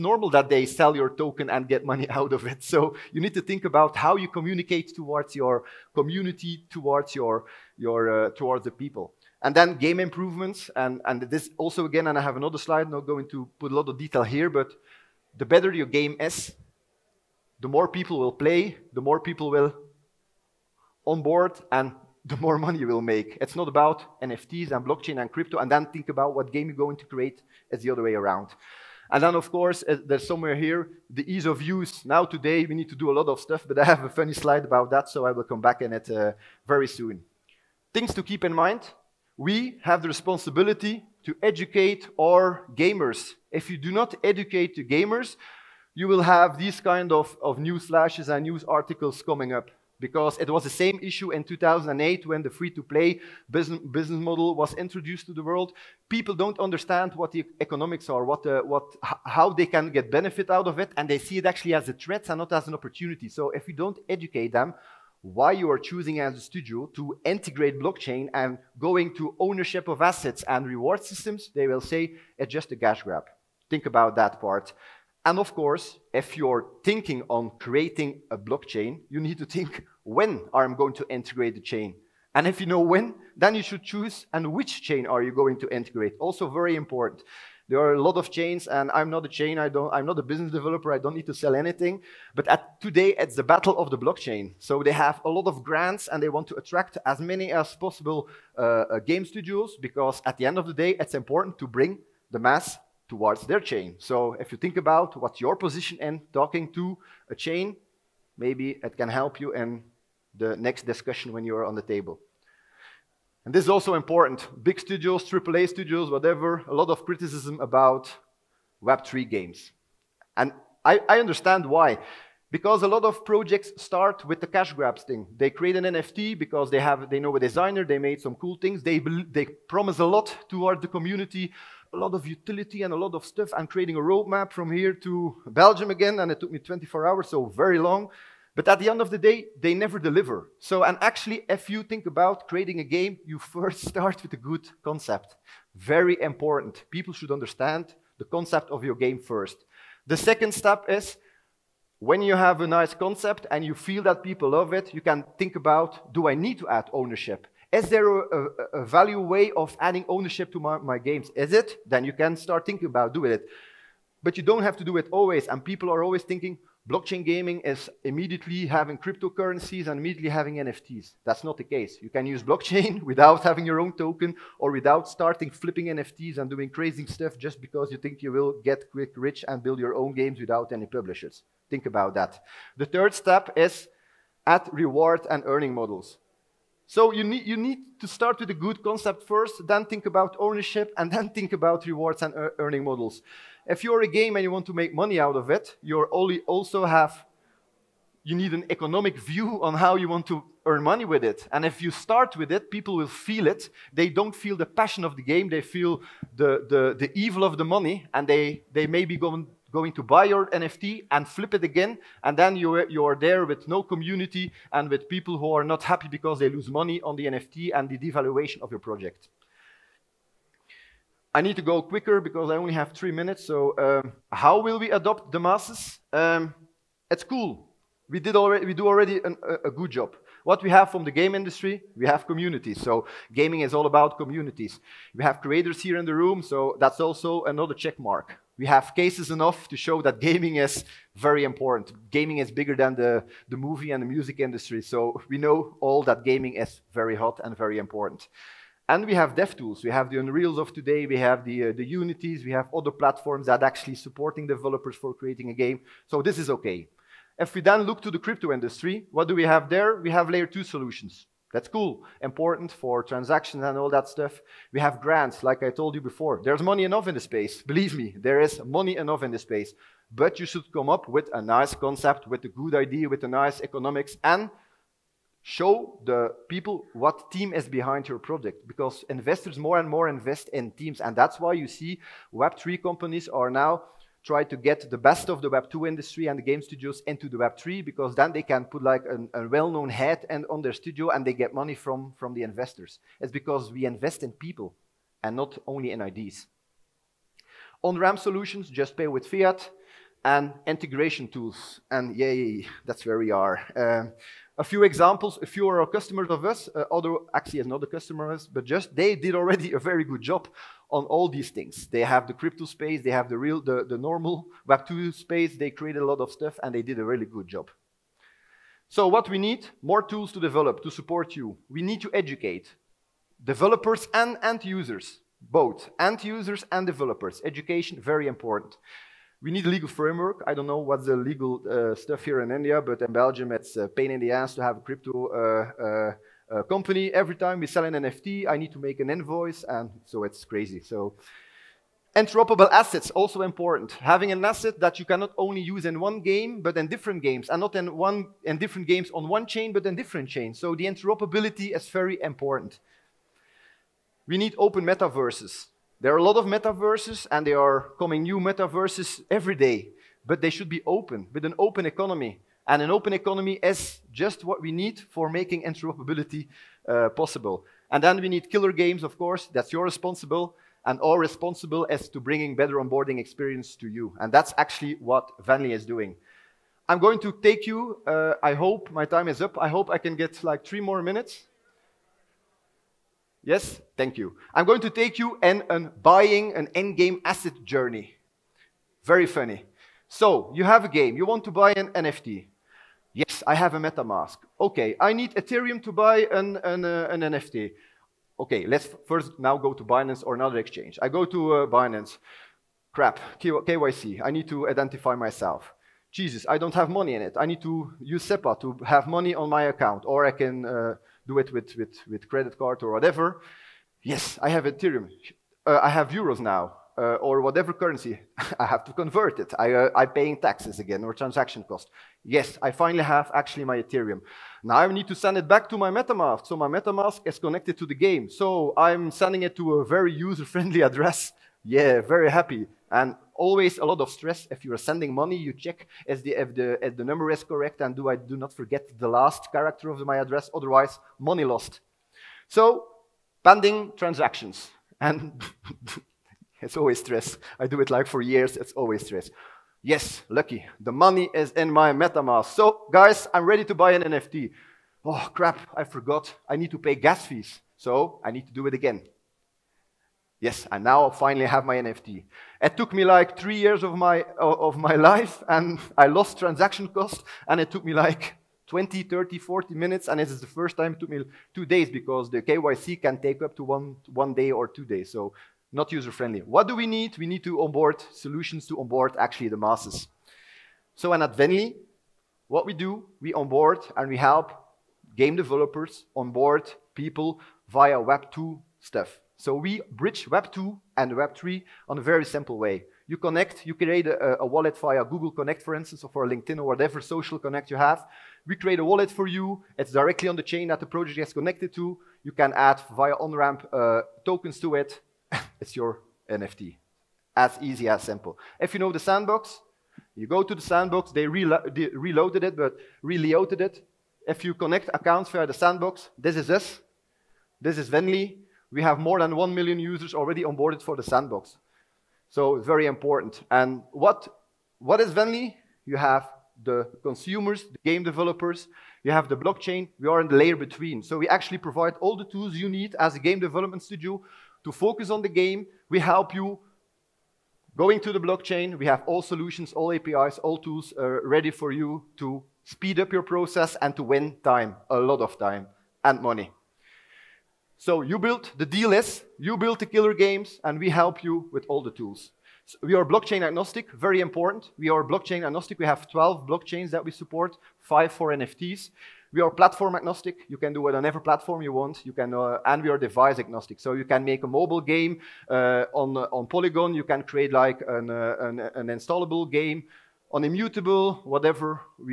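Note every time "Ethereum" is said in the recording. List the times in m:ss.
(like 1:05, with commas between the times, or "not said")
6:35, 6:54, 7:03.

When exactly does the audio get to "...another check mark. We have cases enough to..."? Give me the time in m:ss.
3:57.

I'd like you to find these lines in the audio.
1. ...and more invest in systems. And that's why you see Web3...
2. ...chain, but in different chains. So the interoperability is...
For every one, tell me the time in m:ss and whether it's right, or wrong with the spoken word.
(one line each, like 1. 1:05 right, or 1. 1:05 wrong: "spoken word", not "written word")
1. 4:39 wrong: "teams", not "systems"
2. 5:49 right.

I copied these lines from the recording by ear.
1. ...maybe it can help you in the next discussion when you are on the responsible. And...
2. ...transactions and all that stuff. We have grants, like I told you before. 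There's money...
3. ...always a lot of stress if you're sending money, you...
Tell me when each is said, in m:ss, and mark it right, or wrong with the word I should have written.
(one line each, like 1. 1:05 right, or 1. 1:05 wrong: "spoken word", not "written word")
1. 1:48 wrong: "table", not "responsible"
2. 4:23 right
3. 7:13 right.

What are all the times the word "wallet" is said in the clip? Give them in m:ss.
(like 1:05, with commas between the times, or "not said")
8:14, 8:18.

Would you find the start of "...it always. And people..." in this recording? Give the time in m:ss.
2:44.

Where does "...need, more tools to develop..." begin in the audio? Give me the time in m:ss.
5:19.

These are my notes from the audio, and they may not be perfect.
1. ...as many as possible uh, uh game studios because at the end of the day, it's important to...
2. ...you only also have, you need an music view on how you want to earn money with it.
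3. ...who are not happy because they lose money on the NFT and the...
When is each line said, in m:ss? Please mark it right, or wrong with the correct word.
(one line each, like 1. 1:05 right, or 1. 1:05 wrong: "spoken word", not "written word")
1. 1:37 right
2. 3:15 wrong: "economic", not "music"
3. 3:35 right.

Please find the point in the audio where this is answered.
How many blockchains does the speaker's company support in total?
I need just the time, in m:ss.
9:16.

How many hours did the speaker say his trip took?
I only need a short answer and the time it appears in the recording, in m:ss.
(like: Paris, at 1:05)
24, at 2:16.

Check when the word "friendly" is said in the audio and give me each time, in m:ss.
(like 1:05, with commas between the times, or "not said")
7:10, 7:55.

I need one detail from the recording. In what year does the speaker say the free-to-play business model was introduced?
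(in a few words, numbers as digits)
2008.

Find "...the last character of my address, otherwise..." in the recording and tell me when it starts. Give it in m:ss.
7:19.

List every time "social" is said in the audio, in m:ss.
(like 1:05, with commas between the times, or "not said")
8:17.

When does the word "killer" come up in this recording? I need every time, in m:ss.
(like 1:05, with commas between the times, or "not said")
6:08, 9:09.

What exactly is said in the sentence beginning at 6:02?
And an open economy is just what we need for making interoperability uh, possible.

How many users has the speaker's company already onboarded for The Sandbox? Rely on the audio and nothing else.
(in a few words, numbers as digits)
1 million.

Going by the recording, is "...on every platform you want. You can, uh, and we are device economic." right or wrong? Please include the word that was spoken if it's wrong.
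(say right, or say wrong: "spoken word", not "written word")
wrong: "agnostic", not "economic".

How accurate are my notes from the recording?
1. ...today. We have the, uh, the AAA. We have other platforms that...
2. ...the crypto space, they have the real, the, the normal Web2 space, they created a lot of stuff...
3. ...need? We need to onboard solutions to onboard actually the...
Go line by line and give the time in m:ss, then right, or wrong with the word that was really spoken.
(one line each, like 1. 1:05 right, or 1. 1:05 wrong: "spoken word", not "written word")
1. 4:10 wrong: "Unities", not "AAA"
2. 5:12 right
3. 7:56 right.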